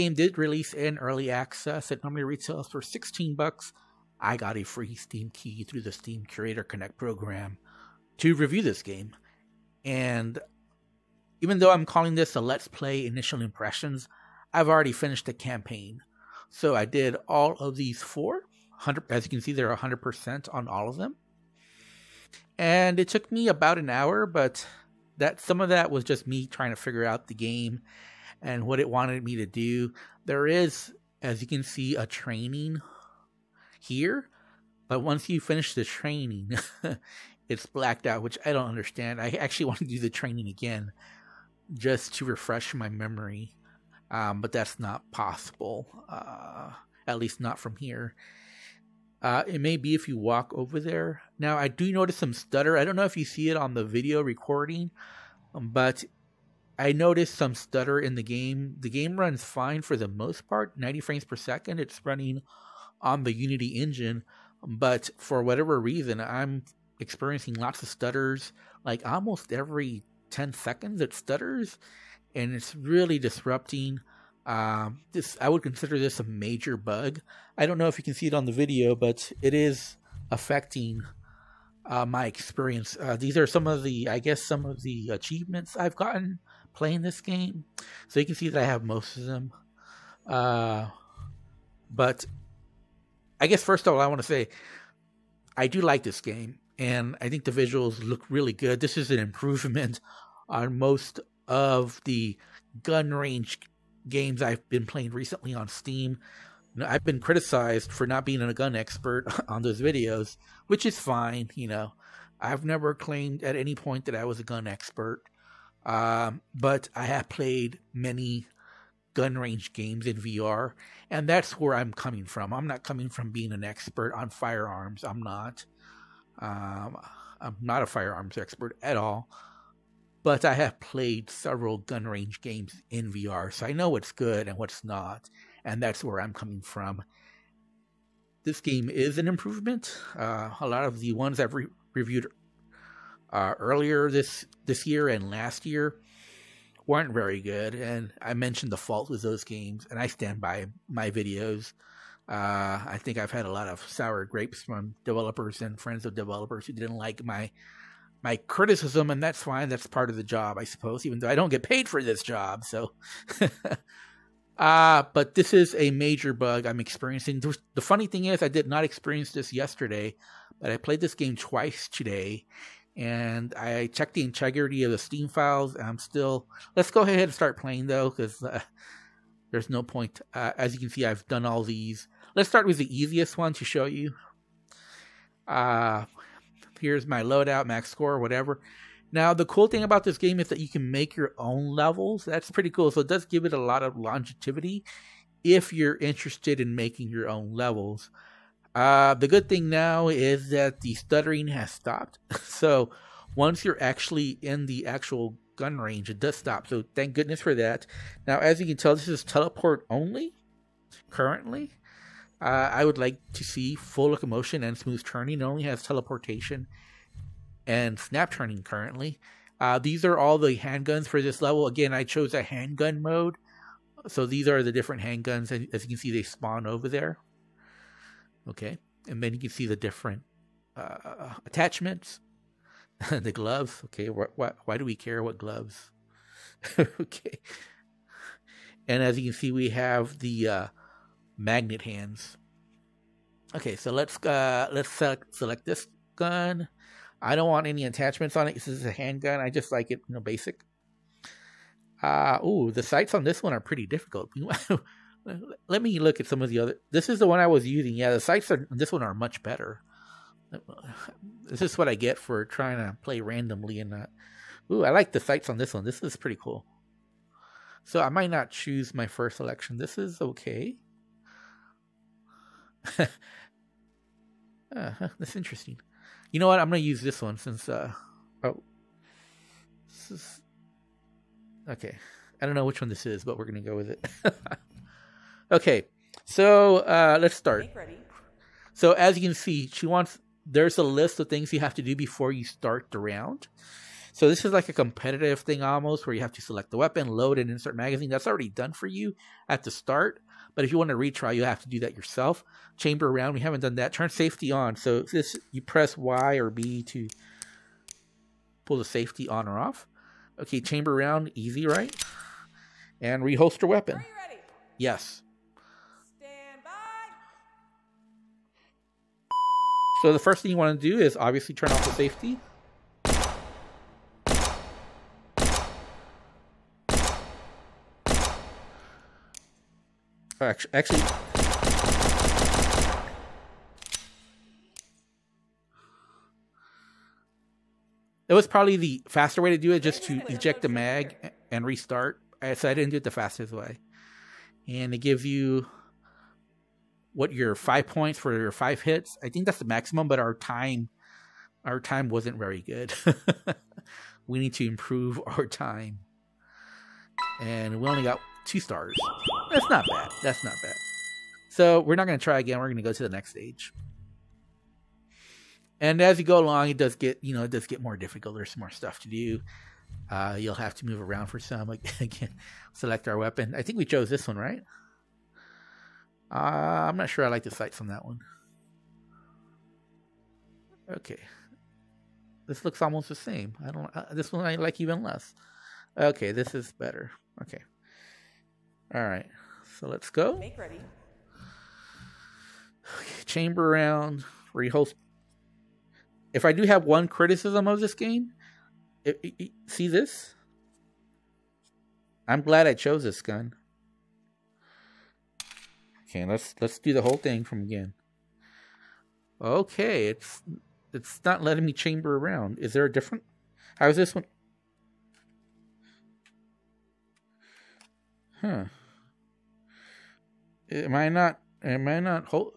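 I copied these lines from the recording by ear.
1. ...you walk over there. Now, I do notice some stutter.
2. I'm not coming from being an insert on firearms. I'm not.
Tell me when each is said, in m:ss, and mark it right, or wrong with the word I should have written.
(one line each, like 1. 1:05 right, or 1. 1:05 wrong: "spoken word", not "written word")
1. 0:50 right
2. 2:02 wrong: "expert", not "insert".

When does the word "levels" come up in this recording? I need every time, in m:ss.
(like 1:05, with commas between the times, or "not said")
3:11, 3:17, 3:41.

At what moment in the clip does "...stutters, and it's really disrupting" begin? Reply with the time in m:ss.
1:11.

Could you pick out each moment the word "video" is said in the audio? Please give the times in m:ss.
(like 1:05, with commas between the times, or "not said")
0:53, 1:18, 1:49, 2:31.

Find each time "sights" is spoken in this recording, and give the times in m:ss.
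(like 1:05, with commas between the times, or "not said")
4:12, 4:18, 4:25, 6:17.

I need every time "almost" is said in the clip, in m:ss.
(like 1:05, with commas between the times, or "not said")
1:09, 4:55, 6:22.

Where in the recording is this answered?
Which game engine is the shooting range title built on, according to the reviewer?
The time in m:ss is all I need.
1:03.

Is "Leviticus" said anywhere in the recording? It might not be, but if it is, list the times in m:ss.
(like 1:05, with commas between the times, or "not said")
not said.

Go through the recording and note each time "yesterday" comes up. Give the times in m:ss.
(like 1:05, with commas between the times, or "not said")
2:49.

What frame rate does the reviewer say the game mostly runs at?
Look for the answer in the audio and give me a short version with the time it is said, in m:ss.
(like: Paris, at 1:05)
90 frames per second, at 1:00.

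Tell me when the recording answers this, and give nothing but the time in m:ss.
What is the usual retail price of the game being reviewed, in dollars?
0:02.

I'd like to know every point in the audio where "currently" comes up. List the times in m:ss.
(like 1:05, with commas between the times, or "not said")
3:31, 3:38.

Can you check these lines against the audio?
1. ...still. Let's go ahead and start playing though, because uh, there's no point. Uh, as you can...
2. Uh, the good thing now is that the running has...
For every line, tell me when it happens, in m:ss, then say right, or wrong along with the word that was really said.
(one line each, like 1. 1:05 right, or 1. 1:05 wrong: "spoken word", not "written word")
1. 2:55 right
2. 3:18 wrong: "stuttering", not "running".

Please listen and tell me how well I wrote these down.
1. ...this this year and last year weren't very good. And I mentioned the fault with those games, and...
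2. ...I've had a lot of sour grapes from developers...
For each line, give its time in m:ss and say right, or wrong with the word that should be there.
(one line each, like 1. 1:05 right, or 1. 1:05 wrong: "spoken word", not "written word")
1. 2:24 right
2. 2:33 right.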